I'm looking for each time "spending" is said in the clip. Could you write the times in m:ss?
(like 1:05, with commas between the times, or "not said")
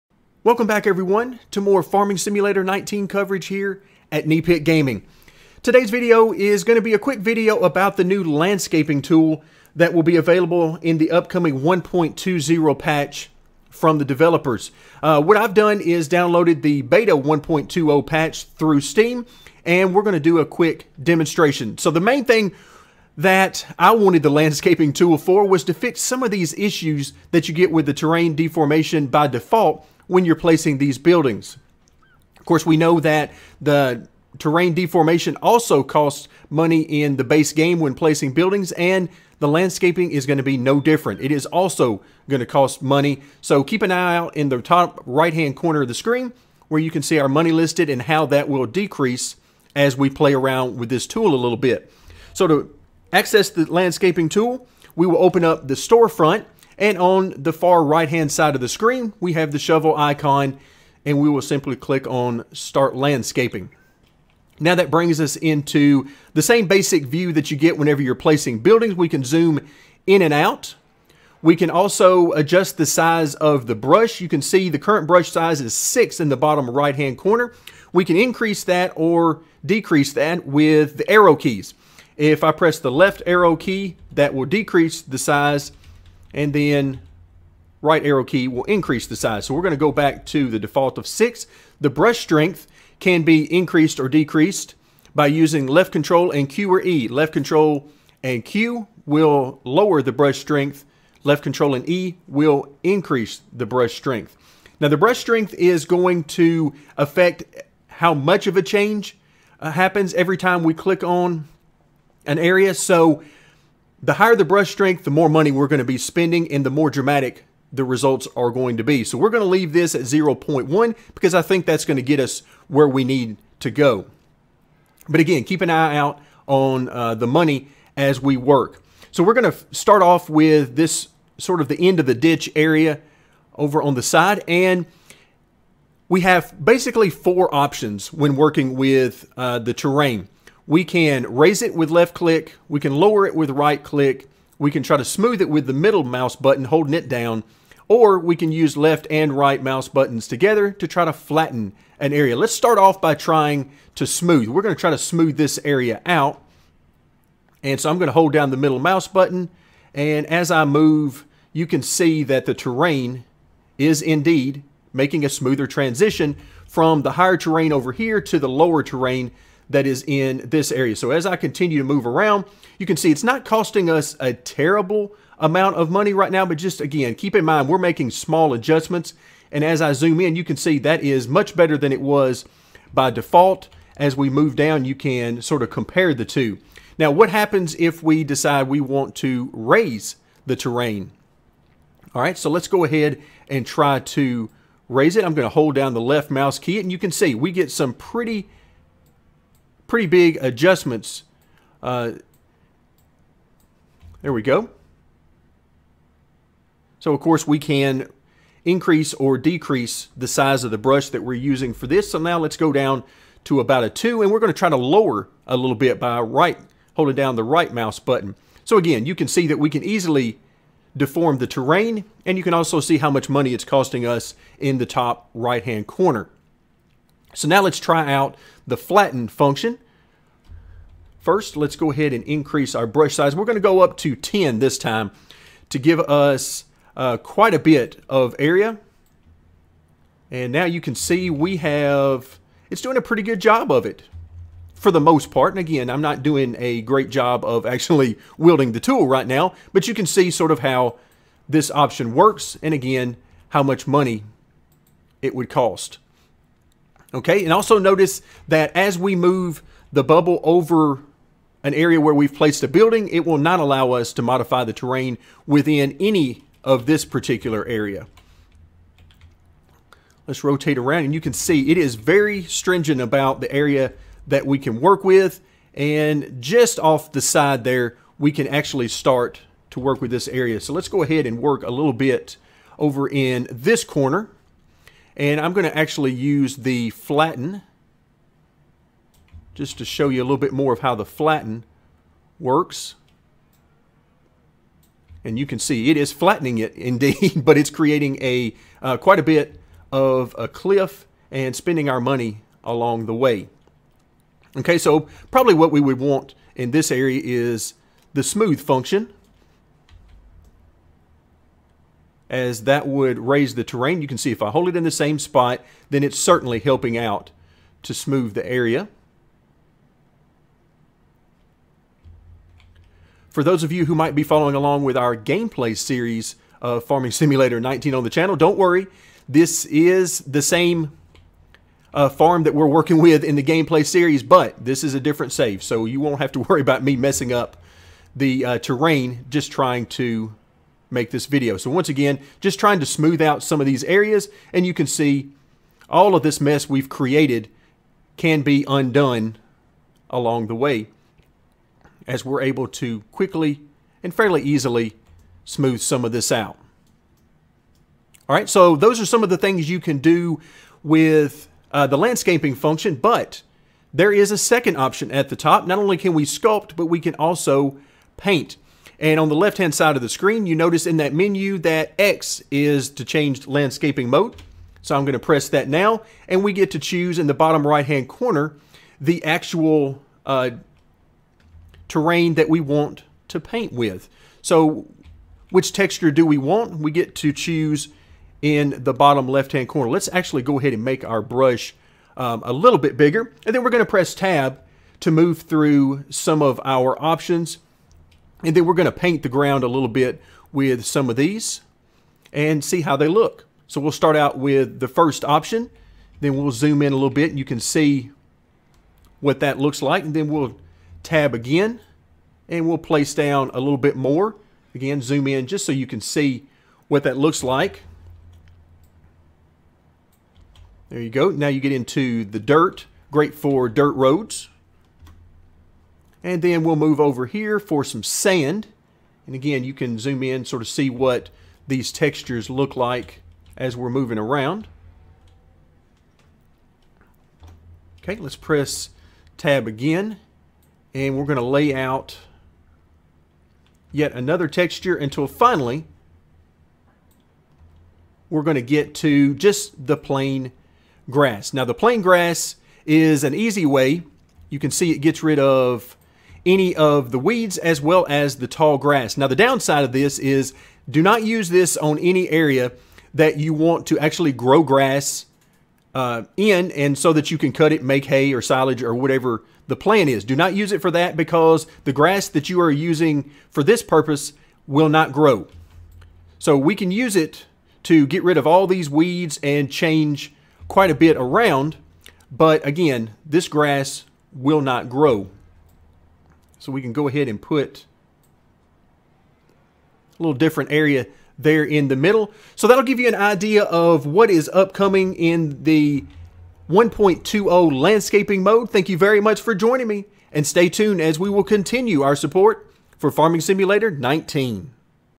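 1:55, 5:01.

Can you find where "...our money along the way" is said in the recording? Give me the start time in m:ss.
5:01.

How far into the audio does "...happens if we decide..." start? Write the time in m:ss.
3:07.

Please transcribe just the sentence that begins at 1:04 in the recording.
Now that brings us into the same basic view that you get whenever you're placing buildings.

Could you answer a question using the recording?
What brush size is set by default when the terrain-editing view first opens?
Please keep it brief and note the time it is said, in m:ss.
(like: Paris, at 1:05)
6, at 1:15.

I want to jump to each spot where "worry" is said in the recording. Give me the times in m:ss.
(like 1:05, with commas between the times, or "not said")
5:28, 5:36.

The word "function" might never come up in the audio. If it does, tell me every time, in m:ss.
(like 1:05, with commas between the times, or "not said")
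3:49, 5:08, 6:02.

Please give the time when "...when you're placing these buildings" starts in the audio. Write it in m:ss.
0:30.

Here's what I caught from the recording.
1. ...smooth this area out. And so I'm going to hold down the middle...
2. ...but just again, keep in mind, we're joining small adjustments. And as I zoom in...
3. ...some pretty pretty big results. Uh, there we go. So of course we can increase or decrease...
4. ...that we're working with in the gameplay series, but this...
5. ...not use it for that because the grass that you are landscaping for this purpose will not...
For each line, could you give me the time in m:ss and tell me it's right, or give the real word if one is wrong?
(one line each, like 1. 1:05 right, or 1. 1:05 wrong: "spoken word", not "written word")
1. 2:34 right
2. 2:56 wrong: "making", not "joining"
3. 3:17 wrong: "adjustments", not "results"
4. 5:32 right
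5. 7:50 wrong: "using", not "landscaping".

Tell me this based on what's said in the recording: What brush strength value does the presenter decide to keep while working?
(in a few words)
0.1.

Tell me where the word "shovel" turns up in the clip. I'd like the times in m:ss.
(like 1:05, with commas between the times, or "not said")
0:59.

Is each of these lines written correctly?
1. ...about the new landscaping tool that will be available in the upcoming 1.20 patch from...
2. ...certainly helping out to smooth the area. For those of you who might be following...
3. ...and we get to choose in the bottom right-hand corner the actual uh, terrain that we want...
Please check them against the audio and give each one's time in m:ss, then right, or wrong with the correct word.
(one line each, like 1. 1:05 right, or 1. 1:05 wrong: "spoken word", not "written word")
1. 0:07 right
2. 5:16 right
3. 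6:16 right.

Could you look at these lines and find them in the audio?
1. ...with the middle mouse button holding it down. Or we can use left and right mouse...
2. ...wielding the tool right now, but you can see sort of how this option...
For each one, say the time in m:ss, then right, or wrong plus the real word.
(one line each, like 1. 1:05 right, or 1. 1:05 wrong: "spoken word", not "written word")
1. 2:25 right
2. 4:08 right.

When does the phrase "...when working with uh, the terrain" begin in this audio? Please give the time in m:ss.
2:18.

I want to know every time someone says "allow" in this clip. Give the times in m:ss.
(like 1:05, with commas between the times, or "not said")
4:23.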